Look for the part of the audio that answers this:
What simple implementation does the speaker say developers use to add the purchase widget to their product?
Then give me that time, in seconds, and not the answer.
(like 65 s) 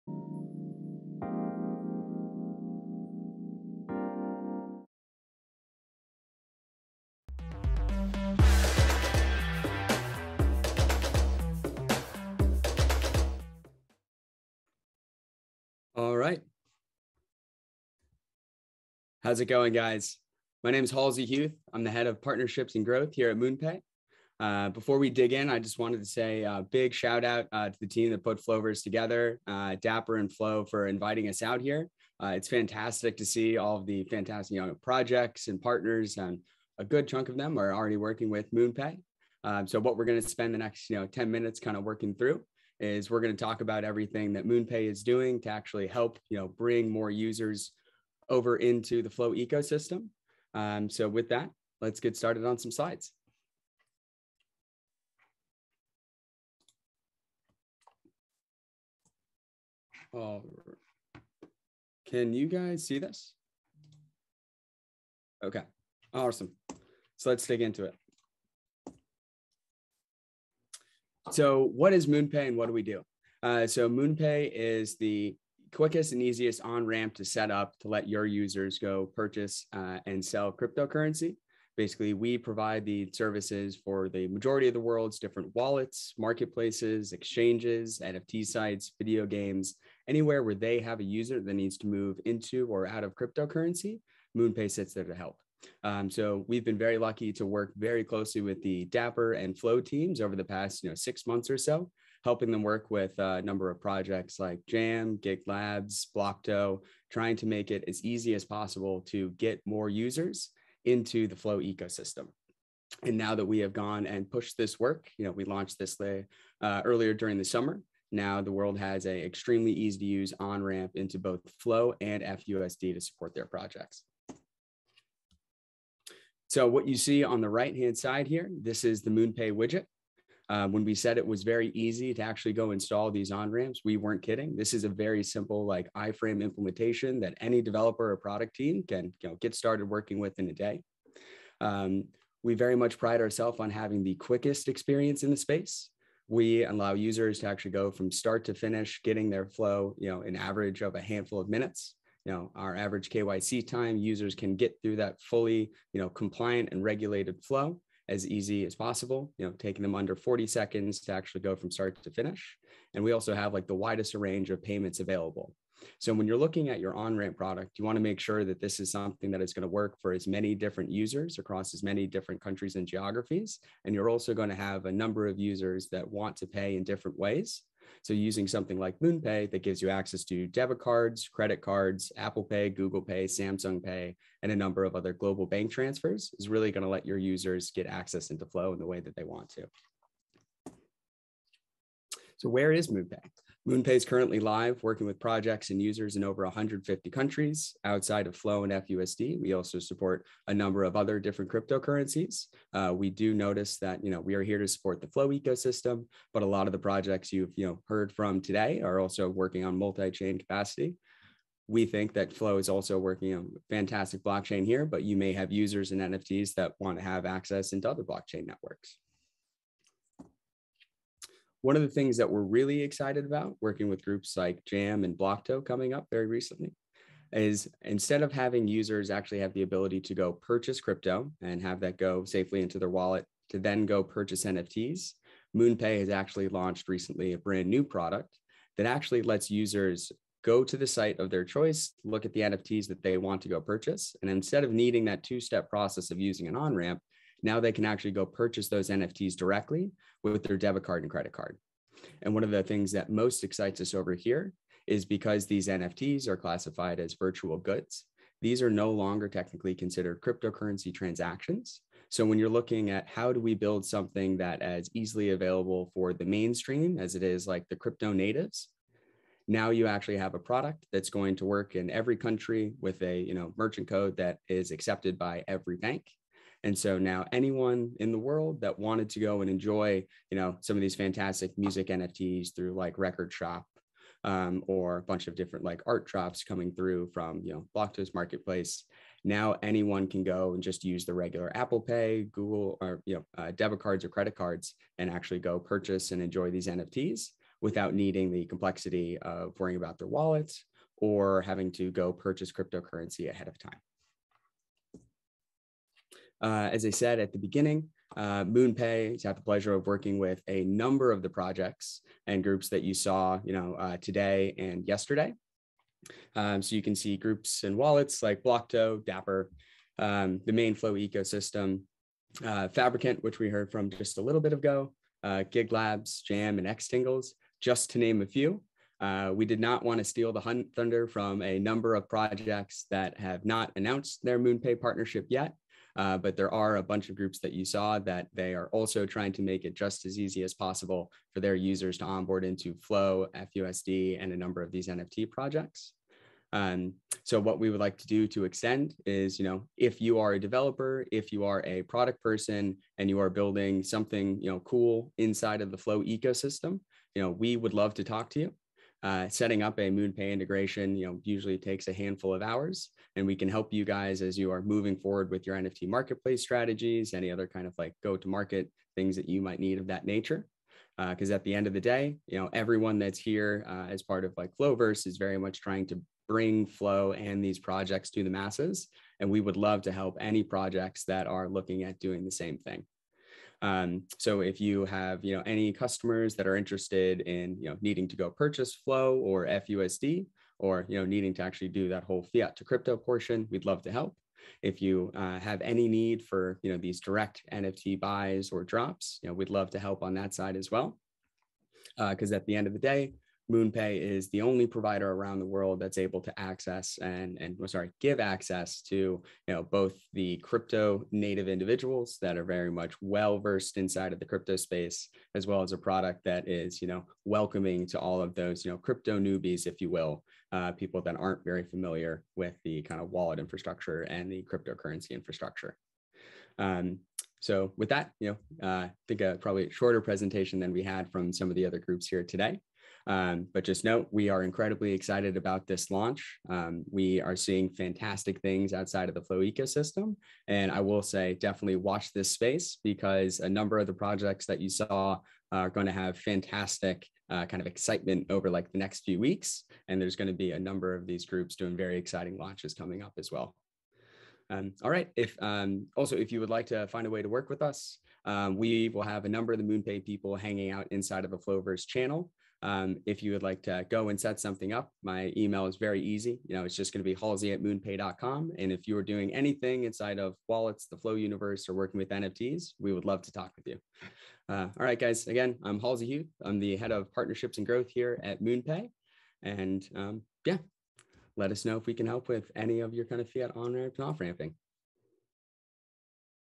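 135 s.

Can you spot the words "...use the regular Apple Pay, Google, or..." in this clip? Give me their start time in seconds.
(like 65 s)
290 s.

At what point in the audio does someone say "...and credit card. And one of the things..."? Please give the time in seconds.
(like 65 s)
251 s.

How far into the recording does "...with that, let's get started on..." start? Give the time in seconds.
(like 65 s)
51 s.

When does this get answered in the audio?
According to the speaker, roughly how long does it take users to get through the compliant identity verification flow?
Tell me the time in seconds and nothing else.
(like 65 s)
159 s.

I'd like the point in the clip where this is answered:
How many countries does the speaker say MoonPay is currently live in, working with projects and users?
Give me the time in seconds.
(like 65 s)
196 s.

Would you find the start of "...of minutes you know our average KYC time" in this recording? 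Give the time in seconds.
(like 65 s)
151 s.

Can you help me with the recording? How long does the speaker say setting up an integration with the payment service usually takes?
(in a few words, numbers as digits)
A handful of hours.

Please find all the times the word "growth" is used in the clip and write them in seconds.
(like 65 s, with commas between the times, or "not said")
22 s, 477 s.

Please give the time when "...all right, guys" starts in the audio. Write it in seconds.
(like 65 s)
474 s.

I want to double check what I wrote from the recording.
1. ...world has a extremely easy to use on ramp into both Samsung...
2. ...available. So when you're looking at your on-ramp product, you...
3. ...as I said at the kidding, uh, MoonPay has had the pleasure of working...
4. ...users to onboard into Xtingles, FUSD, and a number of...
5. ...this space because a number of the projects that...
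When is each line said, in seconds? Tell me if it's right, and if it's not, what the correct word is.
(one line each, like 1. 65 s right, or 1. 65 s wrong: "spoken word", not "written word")
1. 118 s wrong: "Flow", not "Samsung"
2. 164 s right
3. 306 s wrong: "beginning", not "kidding"
4. 341 s wrong: "Flow", not "Xtingles"
5. 442 s right.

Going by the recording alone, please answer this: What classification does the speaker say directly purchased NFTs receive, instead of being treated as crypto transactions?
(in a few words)
Virtual goods.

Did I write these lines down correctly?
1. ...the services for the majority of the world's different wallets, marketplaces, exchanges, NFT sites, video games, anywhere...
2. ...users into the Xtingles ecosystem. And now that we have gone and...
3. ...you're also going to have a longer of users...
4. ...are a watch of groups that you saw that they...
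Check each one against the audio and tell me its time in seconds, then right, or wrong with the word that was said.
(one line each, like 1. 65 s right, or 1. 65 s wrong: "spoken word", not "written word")
1. 82 s right
2. 109 s wrong: "Flow", not "Xtingles"
3. 173 s wrong: "number", not "longer"
4. 336 s wrong: "bunch", not "watch".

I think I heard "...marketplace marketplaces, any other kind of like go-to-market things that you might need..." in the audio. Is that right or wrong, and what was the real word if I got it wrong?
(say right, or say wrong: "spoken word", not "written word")
wrong: "strategies", not "marketplaces".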